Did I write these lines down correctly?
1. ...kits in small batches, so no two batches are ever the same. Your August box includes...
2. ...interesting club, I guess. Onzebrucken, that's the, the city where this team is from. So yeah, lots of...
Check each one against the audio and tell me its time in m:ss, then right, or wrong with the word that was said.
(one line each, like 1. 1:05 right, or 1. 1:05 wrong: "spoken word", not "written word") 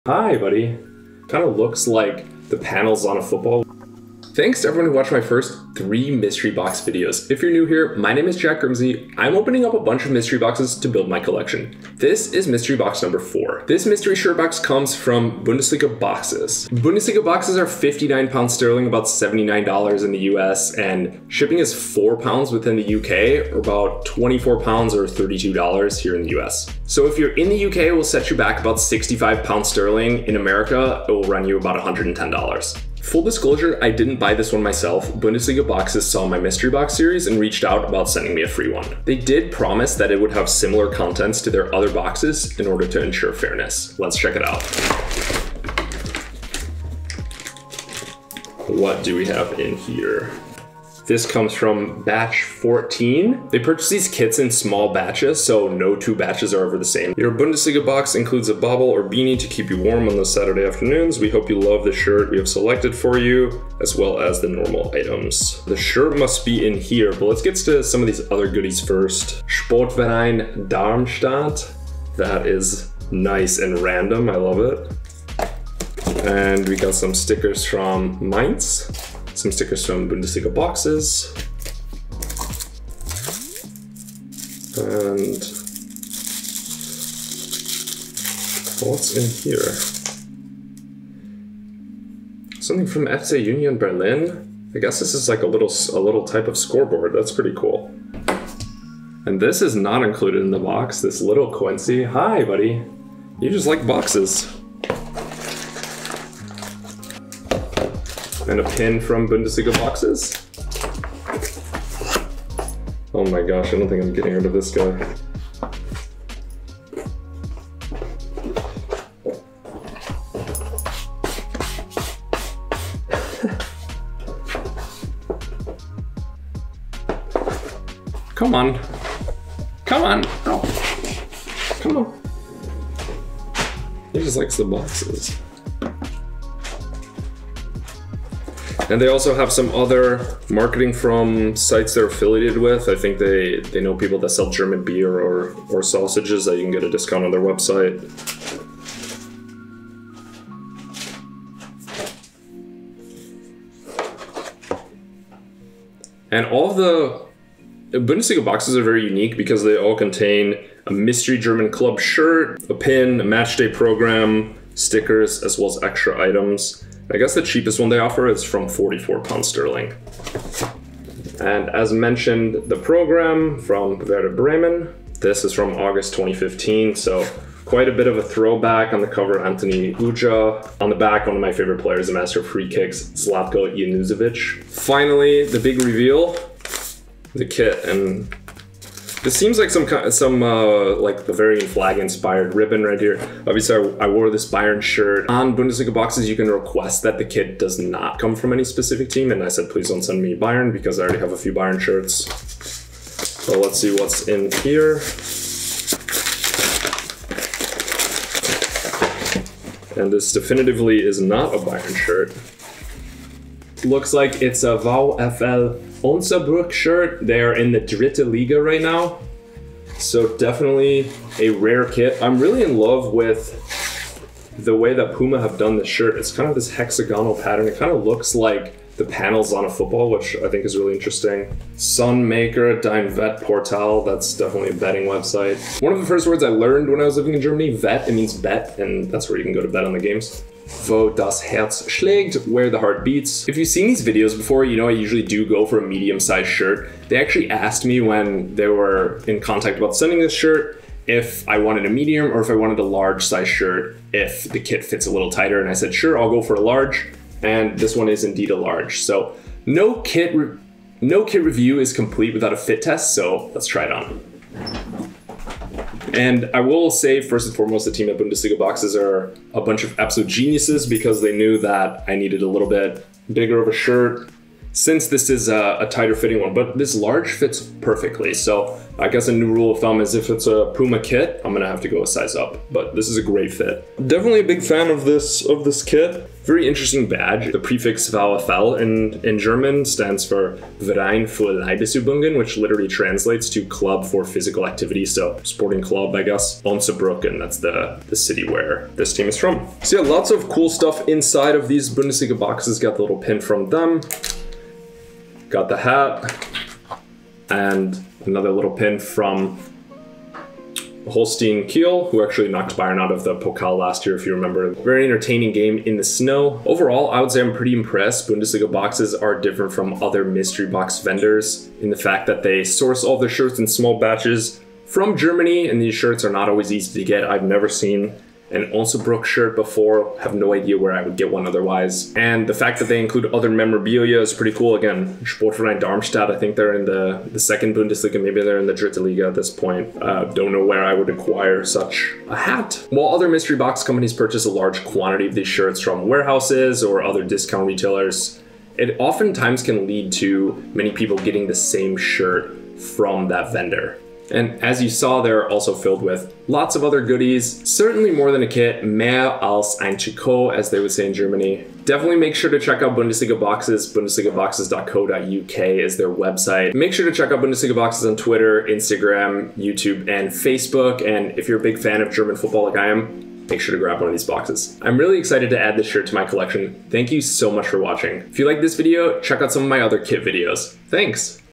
1. 0:54 wrong: "Bundesliga", not "August"
2. 4:55 wrong: "sporting", not "interesting".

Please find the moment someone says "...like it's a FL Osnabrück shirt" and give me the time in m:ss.
3:34.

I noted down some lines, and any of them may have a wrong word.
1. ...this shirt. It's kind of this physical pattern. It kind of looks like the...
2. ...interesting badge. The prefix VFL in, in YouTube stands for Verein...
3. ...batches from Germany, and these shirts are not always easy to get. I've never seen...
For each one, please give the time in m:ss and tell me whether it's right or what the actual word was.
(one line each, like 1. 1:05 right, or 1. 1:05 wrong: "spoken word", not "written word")
1. 3:45 wrong: "hexagonal", not "physical"
2. 4:46 wrong: "German", not "YouTube"
3. 5:23 right.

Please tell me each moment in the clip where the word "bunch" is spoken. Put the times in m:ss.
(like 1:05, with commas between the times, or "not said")
0:09, 4:29.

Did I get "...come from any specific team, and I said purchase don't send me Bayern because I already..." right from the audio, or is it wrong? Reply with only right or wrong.
wrong.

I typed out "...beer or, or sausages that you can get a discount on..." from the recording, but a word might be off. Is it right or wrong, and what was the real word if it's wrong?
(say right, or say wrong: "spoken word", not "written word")
right.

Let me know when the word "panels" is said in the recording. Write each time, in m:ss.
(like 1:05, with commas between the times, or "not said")
0:02, 3:49.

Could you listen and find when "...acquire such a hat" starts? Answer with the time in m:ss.
5:41.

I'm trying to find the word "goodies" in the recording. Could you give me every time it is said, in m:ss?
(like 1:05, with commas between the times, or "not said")
1:08, 5:57.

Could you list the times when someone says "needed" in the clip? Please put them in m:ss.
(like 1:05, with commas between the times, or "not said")
4:32.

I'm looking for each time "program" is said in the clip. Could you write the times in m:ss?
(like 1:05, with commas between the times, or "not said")
2:43, 2:52.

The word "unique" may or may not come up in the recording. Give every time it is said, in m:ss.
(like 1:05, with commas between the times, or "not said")
2:39.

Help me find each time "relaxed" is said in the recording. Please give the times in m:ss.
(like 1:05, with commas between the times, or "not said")
not said.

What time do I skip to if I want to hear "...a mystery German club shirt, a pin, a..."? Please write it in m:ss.
2:40.